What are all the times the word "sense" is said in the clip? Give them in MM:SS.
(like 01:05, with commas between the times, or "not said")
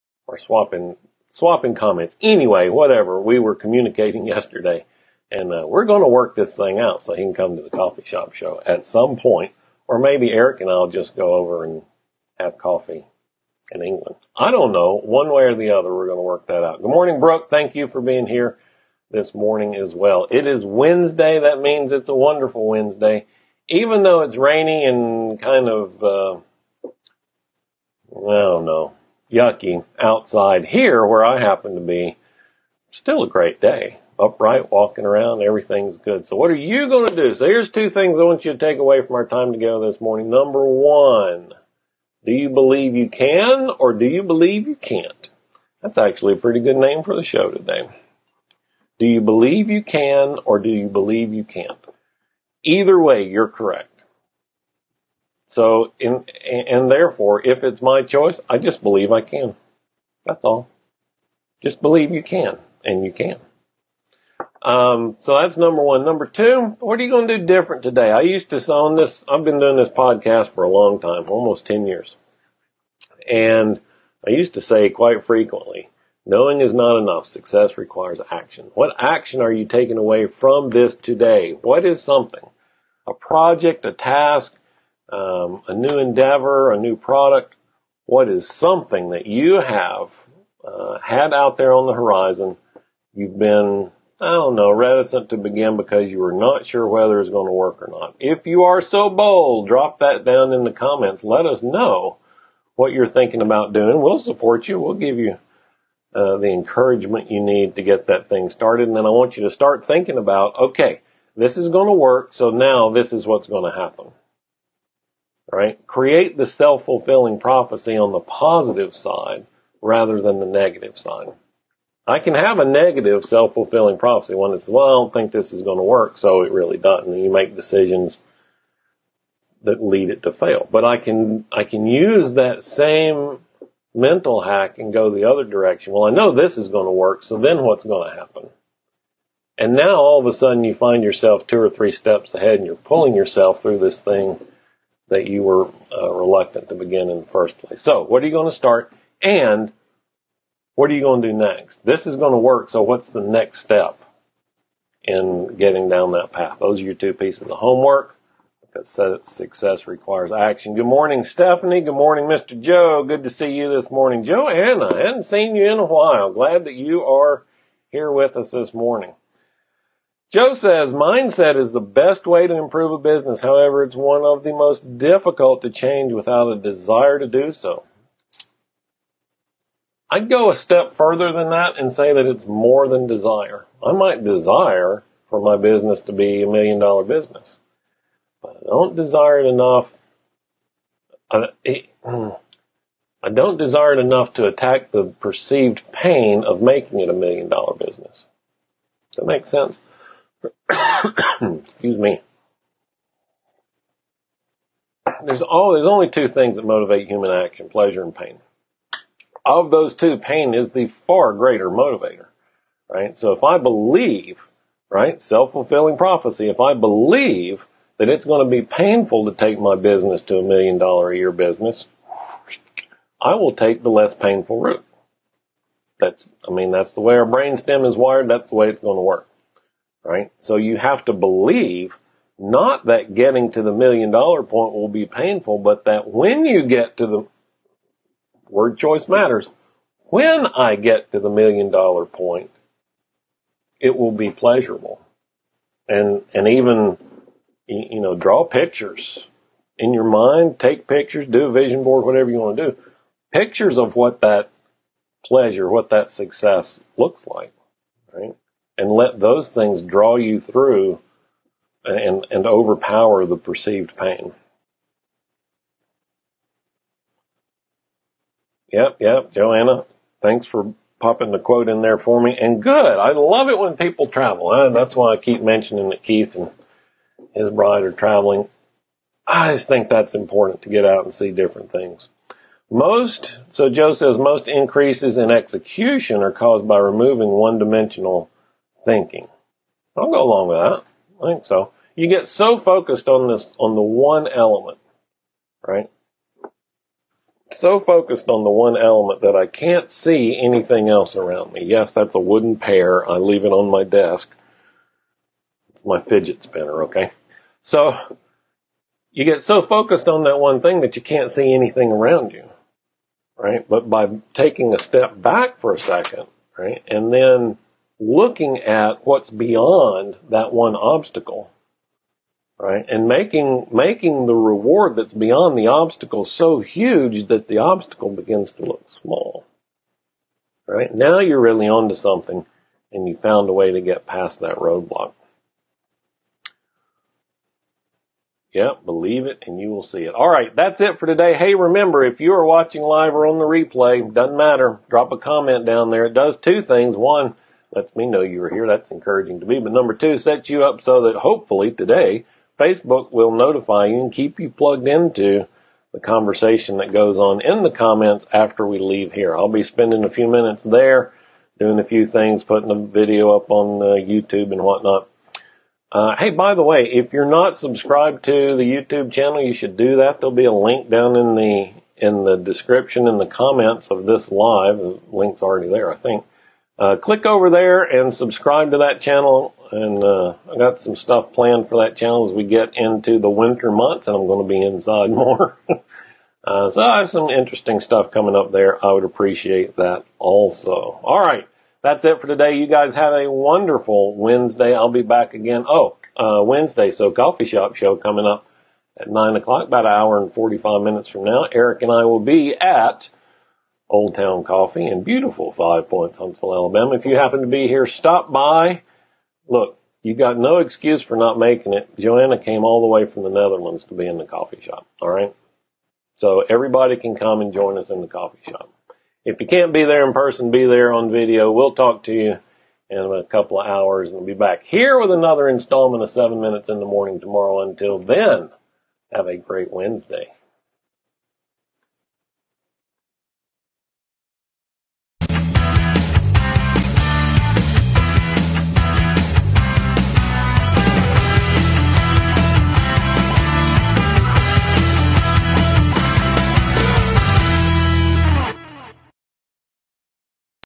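03:19.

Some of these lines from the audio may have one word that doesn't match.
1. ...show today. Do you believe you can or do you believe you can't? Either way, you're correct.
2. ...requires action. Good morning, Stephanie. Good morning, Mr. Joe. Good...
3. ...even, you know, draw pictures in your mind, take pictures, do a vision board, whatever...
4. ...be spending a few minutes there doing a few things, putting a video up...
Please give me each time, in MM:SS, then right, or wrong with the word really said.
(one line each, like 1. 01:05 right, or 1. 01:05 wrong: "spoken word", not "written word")
1. 00:47 right
2. 02:39 right
3. 04:06 right
4. 05:59 right.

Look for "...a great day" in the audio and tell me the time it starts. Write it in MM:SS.
00:33.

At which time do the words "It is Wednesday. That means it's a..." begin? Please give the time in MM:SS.
00:20.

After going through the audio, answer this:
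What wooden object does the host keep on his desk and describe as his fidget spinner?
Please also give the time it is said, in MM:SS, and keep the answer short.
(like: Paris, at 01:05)
wooden pear, at 05:02.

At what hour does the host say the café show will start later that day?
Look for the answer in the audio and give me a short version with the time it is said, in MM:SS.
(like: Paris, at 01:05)
9 o'clock, at 06:39.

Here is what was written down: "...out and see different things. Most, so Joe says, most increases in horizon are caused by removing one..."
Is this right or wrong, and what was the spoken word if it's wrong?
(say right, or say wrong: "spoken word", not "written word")
wrong: "execution", not "horizon".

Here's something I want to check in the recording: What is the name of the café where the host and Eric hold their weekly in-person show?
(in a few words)
Old Town Coffee.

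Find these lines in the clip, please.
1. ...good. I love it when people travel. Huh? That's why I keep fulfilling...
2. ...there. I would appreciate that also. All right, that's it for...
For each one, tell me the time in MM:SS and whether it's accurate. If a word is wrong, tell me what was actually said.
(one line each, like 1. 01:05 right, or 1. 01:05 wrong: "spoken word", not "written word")
1. 04:32 wrong: "mentioning", not "fulfilling"
2. 06:28 right.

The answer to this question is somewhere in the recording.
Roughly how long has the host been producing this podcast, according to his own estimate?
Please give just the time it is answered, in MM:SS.
01:11.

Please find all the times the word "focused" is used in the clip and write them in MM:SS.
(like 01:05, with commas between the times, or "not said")
04:52, 04:57, 05:09.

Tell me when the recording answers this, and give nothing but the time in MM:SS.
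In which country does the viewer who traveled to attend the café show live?
06:53.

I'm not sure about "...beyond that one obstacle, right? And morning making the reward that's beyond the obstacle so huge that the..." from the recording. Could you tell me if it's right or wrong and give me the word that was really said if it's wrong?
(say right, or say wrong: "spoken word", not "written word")
wrong: "making", not "morning".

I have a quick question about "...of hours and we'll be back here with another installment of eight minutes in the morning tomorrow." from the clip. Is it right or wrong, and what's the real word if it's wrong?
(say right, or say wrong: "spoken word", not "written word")
wrong: "seven", not "eight".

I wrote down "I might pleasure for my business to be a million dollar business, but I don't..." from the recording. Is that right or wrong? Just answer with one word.
wrong.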